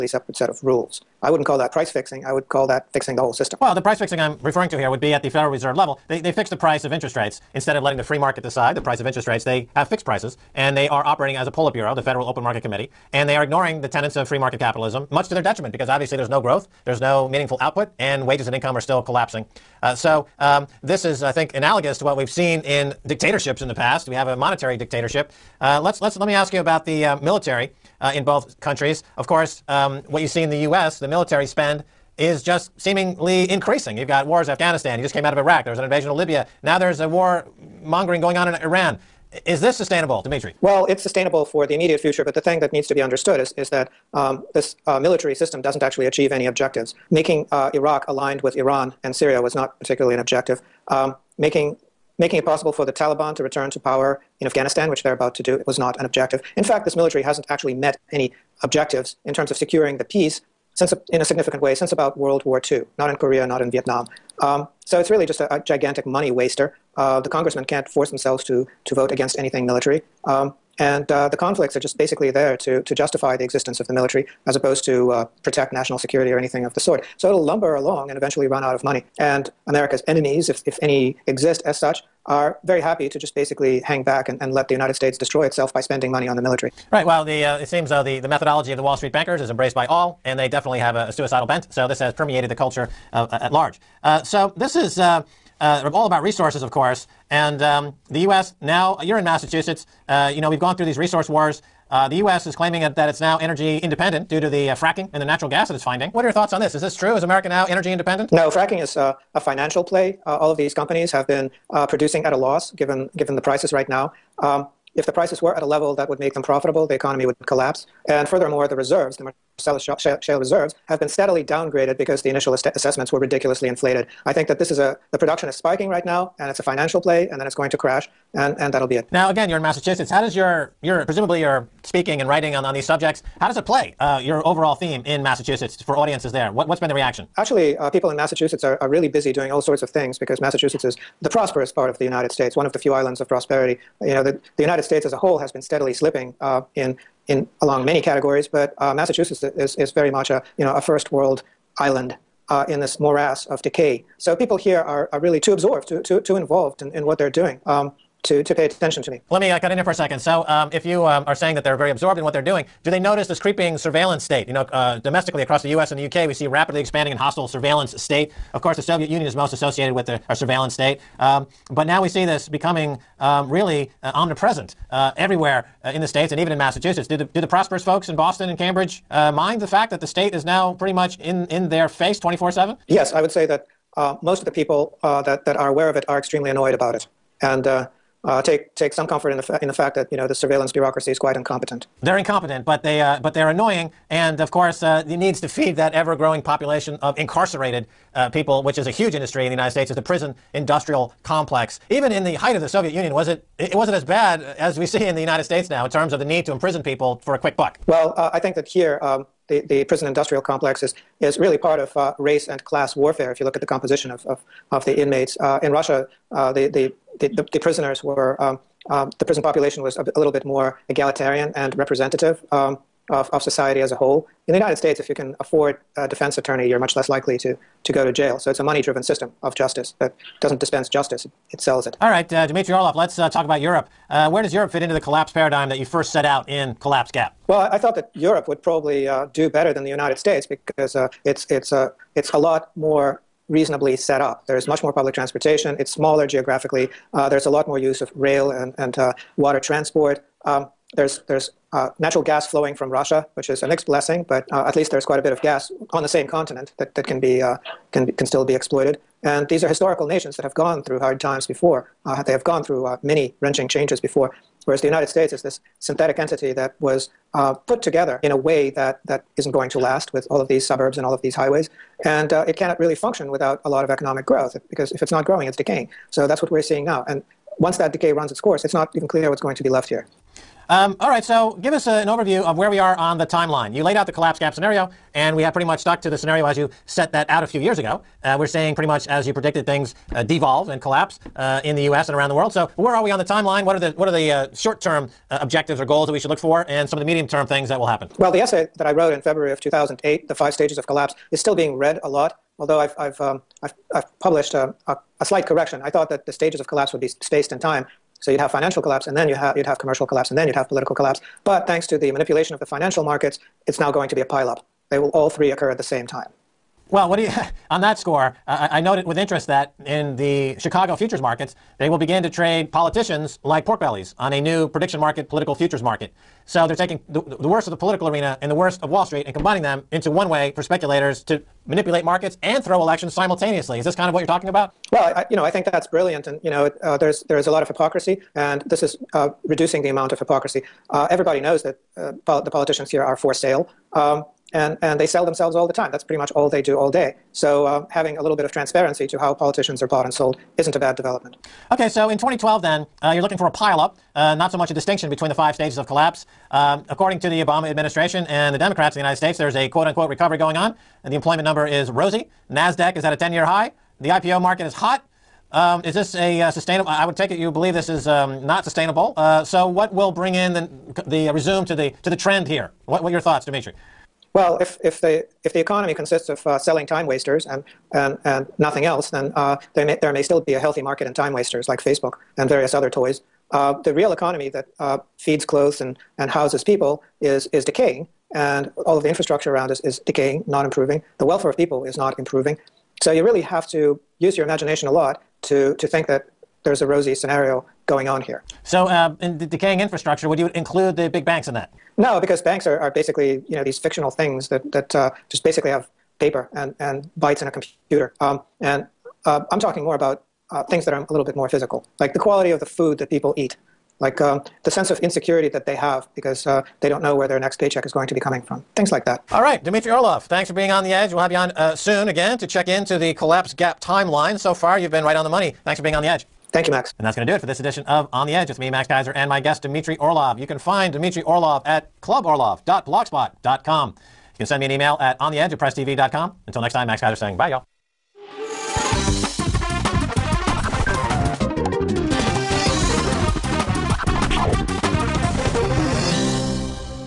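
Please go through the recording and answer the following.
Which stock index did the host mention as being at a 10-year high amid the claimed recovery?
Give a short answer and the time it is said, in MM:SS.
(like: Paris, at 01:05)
NASDAQ, at 06:02.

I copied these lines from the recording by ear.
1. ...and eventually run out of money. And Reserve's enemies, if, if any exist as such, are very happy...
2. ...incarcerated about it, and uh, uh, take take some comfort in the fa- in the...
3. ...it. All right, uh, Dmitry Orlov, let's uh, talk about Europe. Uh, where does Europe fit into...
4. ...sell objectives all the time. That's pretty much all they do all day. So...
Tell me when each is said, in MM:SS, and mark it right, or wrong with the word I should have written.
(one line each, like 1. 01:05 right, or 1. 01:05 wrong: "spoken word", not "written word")
1. 01:18 wrong: "America", not "Reserve"
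2. 03:06 wrong: "annoyed", not "incarcerated"
3. 03:51 right
4. 05:45 wrong: "themselves", not "objectives".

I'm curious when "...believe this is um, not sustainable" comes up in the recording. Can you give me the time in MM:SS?
06:07.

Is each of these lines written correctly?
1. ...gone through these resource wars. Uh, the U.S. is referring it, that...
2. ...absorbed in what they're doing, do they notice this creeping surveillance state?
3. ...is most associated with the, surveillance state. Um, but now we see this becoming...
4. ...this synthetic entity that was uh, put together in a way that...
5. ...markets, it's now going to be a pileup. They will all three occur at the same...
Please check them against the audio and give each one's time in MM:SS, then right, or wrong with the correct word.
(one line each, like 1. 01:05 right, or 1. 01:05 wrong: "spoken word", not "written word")
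1. 01:40 wrong: "claiming", not "referring"
2. 02:41 right
3. 02:49 right
4. 04:25 right
5. 05:13 right.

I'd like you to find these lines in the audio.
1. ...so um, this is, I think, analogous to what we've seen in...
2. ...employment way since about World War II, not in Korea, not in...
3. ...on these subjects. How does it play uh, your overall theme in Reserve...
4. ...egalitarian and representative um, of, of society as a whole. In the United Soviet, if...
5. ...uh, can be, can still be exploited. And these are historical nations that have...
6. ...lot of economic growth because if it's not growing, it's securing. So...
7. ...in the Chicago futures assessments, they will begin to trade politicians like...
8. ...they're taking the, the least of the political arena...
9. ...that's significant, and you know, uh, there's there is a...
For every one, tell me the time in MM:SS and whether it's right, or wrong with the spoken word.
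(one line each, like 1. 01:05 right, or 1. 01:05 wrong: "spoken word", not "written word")
1. 00:19 right
2. 01:01 wrong: "significant", not "employment"
3. 02:12 wrong: "Massachusetts", not "Reserve"
4. 03:40 wrong: "States", not "Soviet"
5. 04:17 right
6. 04:33 wrong: "decaying", not "securing"
7. 05:19 wrong: "markets", not "assessments"
8. 05:26 wrong: "worst", not "least"
9. 05:35 wrong: "brilliant", not "significant".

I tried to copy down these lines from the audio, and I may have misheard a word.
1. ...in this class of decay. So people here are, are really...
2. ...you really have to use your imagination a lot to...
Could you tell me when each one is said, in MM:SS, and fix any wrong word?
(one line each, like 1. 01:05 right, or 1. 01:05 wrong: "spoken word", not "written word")
1. 02:32 wrong: "morass", not "class"
2. 06:33 right.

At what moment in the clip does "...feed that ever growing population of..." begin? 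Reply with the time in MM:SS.
03:15.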